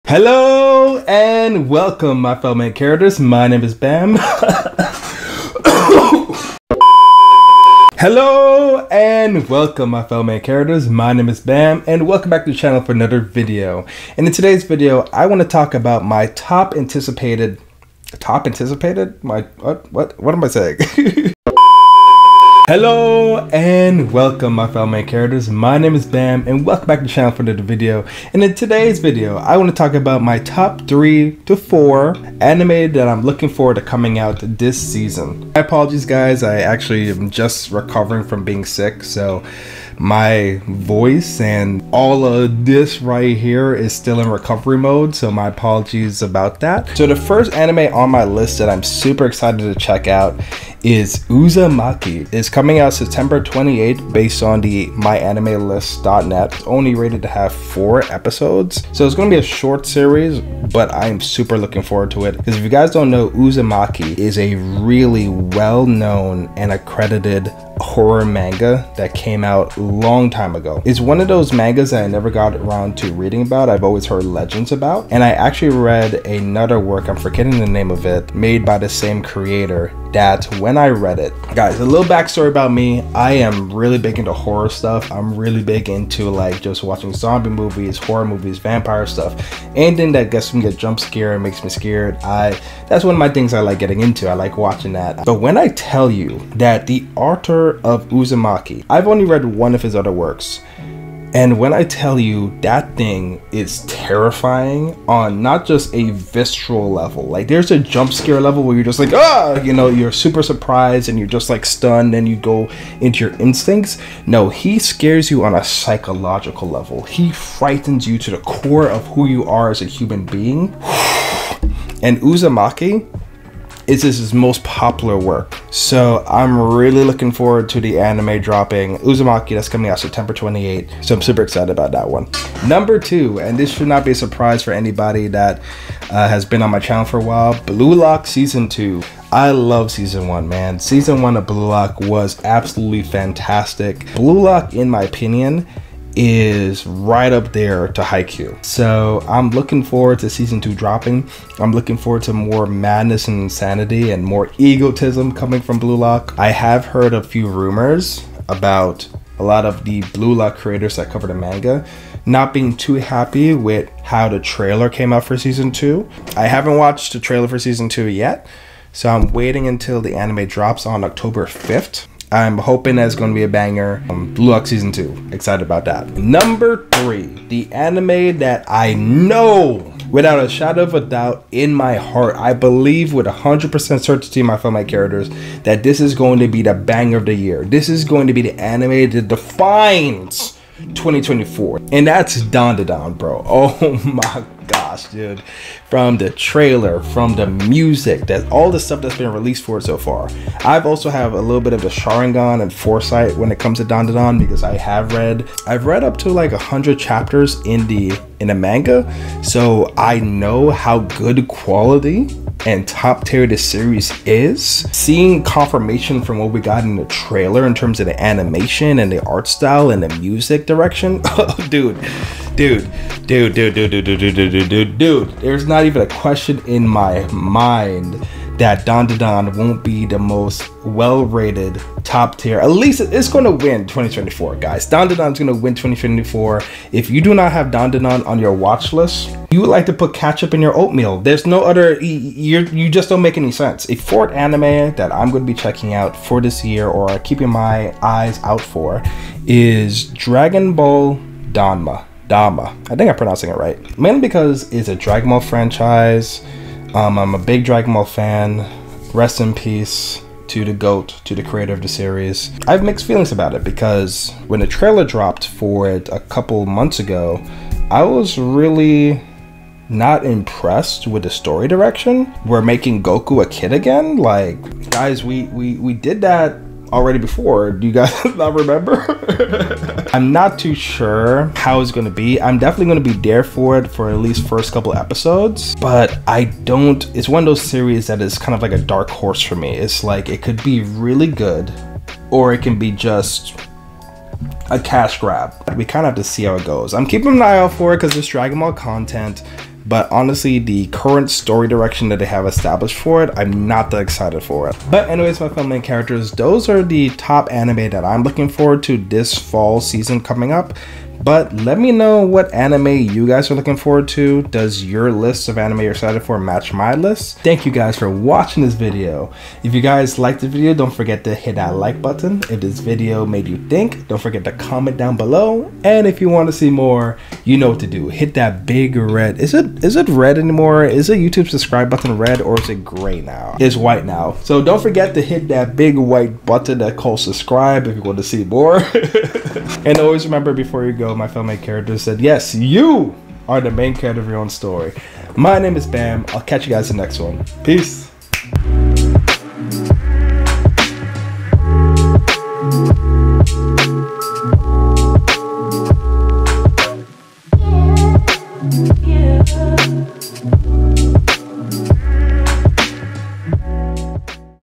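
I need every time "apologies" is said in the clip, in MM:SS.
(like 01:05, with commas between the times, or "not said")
00:35, 00:45.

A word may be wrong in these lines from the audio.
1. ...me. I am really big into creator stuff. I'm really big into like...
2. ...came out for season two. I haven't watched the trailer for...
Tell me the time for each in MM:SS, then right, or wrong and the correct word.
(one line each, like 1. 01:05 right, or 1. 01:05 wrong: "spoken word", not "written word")
1. 01:22 wrong: "horror", not "creator"
2. 02:44 right.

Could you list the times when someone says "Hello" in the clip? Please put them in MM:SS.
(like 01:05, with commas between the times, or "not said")
00:00, 00:07, 00:22.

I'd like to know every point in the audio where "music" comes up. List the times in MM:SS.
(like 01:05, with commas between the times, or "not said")
03:17, 03:40.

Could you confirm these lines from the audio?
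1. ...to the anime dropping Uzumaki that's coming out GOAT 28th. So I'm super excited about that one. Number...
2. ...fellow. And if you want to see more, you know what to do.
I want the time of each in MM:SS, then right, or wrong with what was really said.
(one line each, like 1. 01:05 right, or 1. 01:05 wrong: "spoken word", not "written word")
1. 02:07 wrong: "September", not "GOAT"
2. 05:25 wrong: "below", not "fellow".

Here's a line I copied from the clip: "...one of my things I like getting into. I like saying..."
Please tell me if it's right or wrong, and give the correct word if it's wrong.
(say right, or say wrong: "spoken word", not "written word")
wrong: "watching", not "saying".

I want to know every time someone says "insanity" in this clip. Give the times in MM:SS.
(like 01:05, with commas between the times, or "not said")
02:33.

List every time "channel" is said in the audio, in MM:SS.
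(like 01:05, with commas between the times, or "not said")
00:12, 00:27, 02:16.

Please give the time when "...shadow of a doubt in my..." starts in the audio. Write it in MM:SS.
03:00.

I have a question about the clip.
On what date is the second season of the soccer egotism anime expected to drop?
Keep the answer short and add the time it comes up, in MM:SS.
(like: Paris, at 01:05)
October 5th, at 02:51.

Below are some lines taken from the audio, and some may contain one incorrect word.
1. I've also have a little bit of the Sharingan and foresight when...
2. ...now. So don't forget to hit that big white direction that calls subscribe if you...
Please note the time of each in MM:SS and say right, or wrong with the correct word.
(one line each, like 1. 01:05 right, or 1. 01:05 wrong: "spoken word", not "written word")
1. 03:20 right
2. 05:34 wrong: "button", not "direction".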